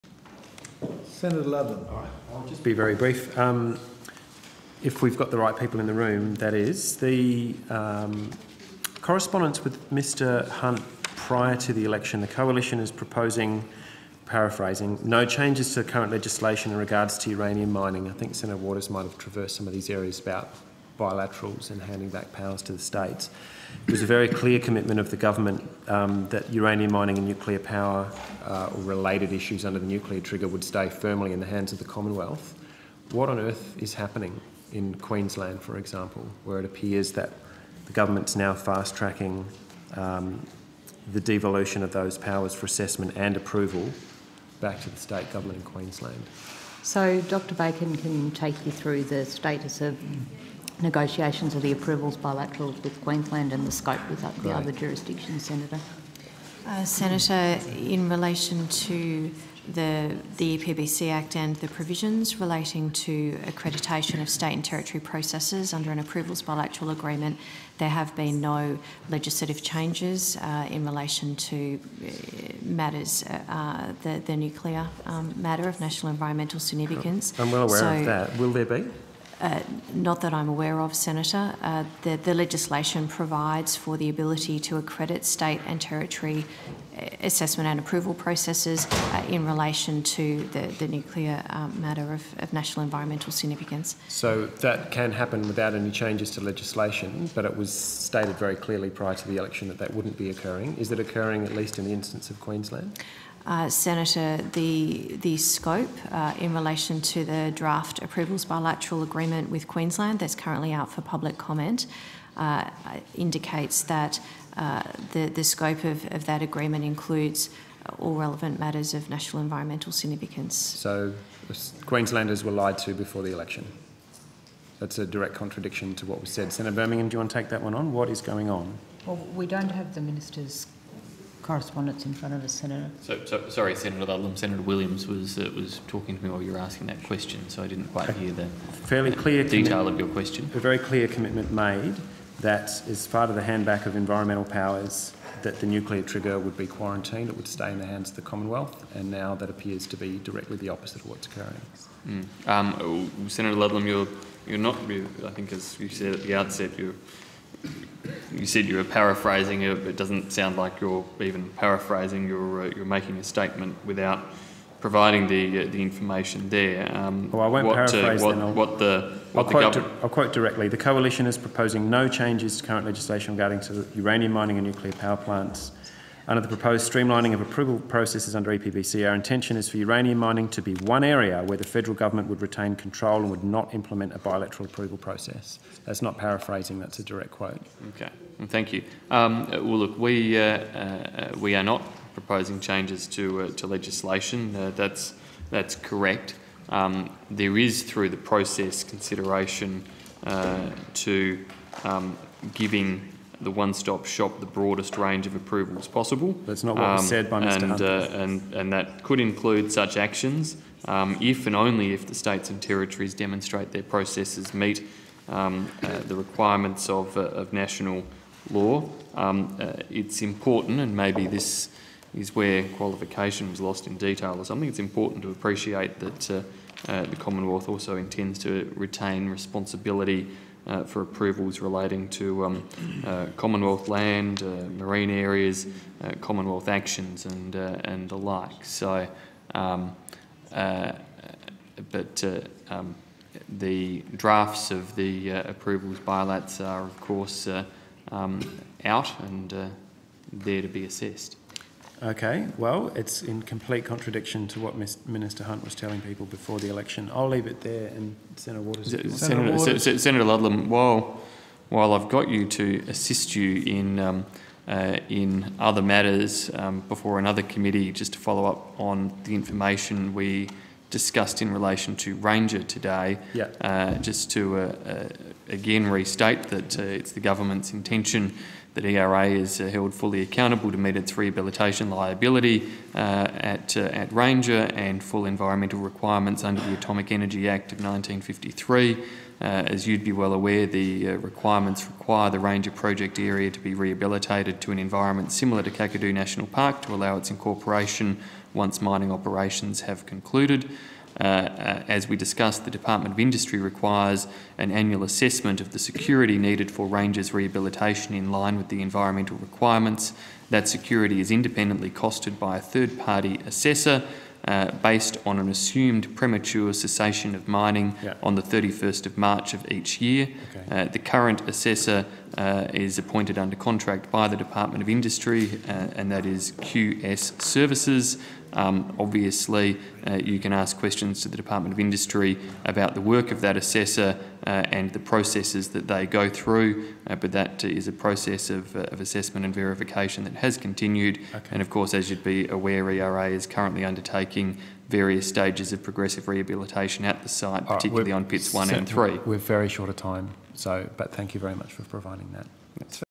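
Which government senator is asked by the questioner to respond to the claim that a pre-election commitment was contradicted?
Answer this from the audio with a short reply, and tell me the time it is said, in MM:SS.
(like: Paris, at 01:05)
Senator Birmingham, at 02:06.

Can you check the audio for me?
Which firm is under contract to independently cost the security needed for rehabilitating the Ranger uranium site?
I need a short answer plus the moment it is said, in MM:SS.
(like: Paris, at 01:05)
QS Services, at 05:26.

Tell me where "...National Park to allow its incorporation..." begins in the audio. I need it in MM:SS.
04:56.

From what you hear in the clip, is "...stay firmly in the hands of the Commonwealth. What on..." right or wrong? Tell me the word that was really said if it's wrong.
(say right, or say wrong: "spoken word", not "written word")
right.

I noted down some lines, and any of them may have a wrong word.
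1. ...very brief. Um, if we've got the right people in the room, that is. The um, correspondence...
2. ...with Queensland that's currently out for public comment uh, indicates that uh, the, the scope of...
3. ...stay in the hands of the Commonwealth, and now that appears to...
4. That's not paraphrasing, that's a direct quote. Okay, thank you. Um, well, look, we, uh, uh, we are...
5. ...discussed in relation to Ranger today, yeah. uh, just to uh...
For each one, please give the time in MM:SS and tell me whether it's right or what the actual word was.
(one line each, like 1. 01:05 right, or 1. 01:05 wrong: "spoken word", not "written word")
1. 00:02 right
2. 01:49 right
3. 02:27 right
4. 03:05 right
5. 04:30 right.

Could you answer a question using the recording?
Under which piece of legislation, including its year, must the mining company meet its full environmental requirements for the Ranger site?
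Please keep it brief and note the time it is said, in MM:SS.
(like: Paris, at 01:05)
Atomic Energy Act of 1953, at 04:46.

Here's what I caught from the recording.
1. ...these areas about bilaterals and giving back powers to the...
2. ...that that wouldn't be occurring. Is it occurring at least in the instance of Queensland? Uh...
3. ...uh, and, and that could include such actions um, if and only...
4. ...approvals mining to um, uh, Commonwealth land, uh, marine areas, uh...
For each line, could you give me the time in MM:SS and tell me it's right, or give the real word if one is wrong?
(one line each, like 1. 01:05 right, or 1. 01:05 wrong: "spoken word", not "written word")
1. 00:19 wrong: "handing", not "giving"
2. 01:39 right
3. 03:27 right
4. 03:51 wrong: "relating", not "mining".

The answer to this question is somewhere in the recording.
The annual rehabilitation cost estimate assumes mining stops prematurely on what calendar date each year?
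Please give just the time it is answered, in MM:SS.
05:18.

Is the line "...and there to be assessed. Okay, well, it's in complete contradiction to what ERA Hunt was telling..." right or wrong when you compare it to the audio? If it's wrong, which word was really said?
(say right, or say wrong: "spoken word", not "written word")
wrong: "Minister", not "ERA".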